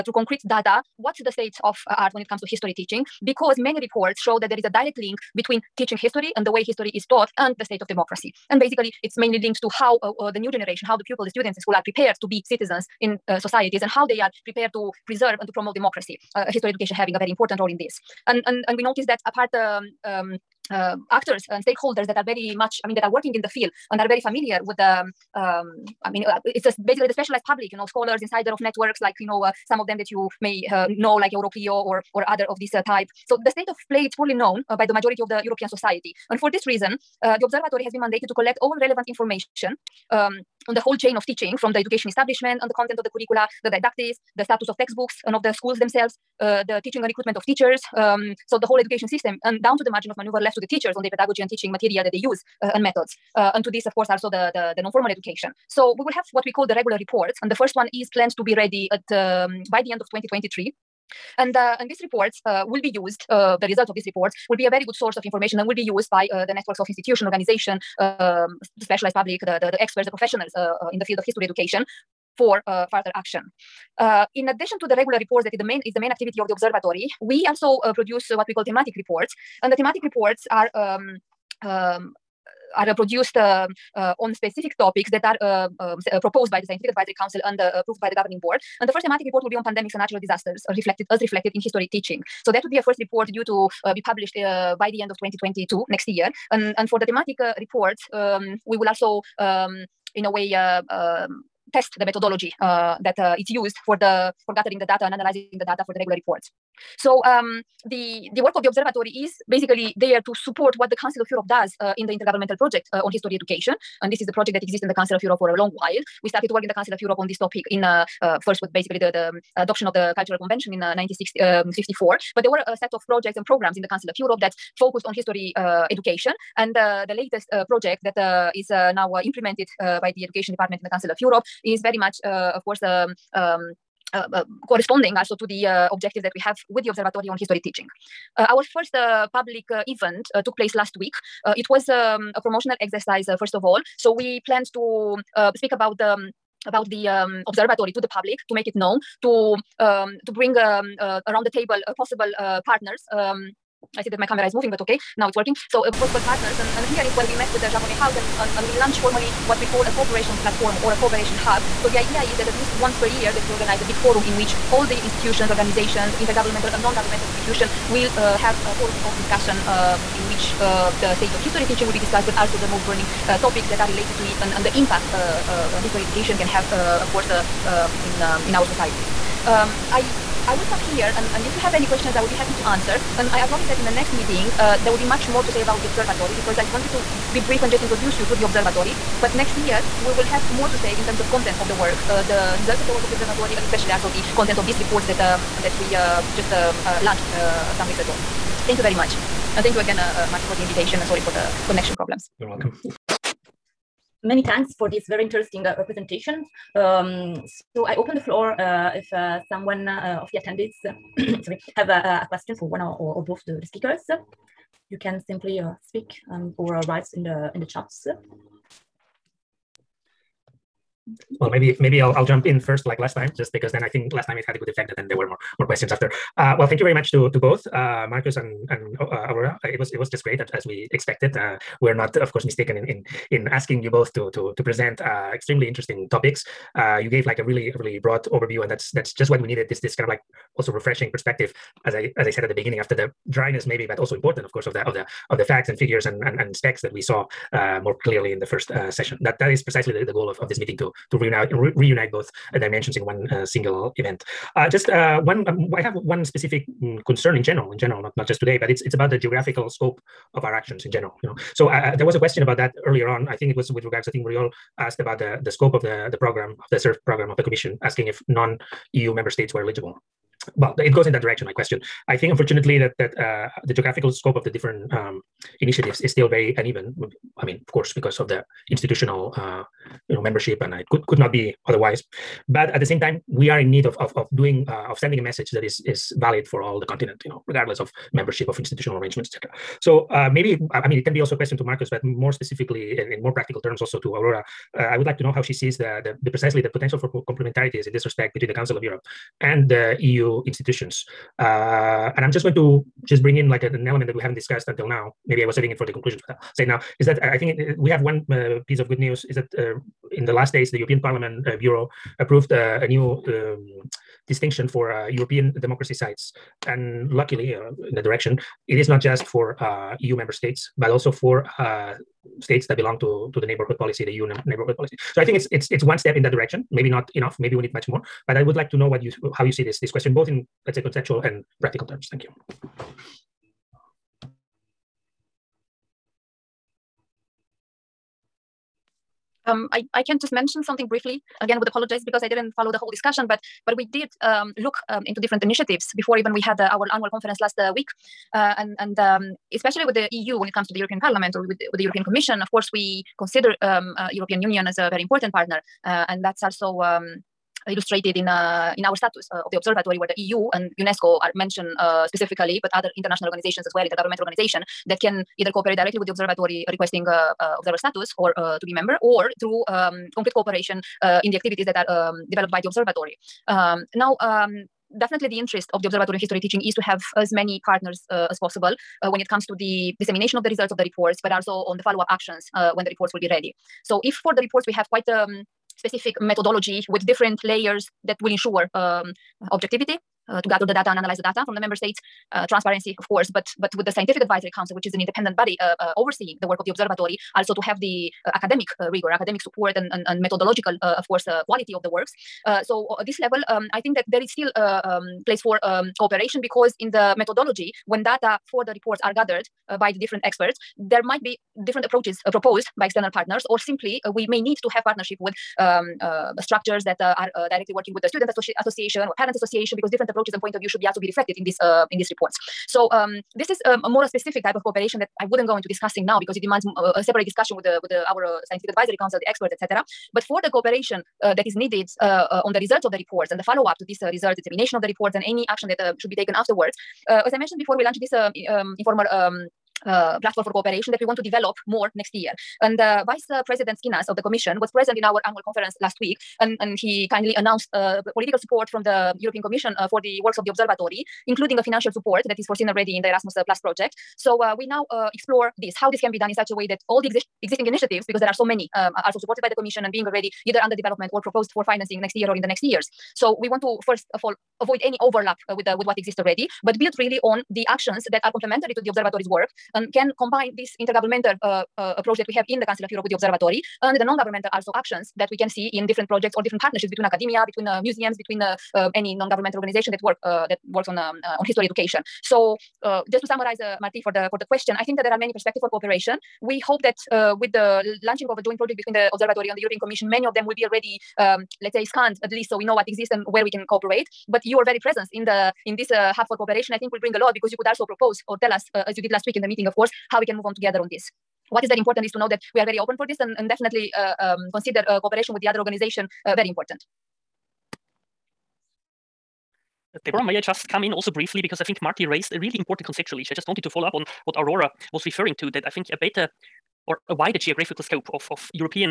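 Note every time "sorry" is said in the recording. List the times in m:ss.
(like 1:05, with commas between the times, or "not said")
3:21, 3:31.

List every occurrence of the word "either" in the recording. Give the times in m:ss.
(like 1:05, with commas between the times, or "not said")
6:05, 7:40.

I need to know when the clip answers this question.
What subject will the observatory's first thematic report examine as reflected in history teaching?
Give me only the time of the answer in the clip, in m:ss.
1:29.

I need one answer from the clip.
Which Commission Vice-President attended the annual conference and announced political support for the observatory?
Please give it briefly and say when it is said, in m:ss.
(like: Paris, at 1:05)
Schinas, at 7:23.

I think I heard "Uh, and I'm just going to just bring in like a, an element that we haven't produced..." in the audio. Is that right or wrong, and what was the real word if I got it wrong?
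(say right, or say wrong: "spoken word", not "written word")
wrong: "discussed", not "produced".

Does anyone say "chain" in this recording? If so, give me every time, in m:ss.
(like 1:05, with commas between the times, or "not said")
0:40.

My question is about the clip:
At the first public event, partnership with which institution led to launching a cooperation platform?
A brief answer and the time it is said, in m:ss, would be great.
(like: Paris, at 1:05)
Jean Monnet House, at 2:37.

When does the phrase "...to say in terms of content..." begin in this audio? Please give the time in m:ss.
3:10.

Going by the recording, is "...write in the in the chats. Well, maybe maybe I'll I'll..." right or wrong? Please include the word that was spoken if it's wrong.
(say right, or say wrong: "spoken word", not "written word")
right.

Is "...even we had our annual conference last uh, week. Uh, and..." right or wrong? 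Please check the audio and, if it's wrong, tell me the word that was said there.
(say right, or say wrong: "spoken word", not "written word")
right.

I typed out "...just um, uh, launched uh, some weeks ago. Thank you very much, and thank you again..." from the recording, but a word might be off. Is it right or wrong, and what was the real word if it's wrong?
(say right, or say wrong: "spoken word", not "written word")
right.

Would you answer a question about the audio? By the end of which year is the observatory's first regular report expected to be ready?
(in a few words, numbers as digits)
2023.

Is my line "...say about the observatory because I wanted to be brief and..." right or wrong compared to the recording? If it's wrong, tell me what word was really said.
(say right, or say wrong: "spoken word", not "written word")
right.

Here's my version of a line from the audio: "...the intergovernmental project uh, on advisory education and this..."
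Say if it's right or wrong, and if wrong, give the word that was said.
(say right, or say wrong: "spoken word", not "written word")
wrong: "history", not "advisory".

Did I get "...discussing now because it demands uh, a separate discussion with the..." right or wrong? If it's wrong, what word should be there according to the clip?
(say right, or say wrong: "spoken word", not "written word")
right.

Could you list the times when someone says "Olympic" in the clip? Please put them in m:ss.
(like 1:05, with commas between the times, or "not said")
not said.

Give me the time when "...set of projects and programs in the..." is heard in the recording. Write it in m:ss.
2:02.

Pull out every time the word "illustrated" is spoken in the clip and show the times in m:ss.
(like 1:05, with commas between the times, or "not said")
5:57.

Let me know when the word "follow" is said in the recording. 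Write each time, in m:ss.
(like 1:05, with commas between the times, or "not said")
5:42, 6:21, 7:13, 8:33.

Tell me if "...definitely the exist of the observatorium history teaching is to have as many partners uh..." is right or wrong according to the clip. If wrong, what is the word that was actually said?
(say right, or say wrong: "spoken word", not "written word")
wrong: "interest", not "exist".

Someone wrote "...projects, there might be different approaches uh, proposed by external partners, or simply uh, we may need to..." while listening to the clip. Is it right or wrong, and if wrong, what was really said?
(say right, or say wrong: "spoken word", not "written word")
wrong: "experts", not "projects".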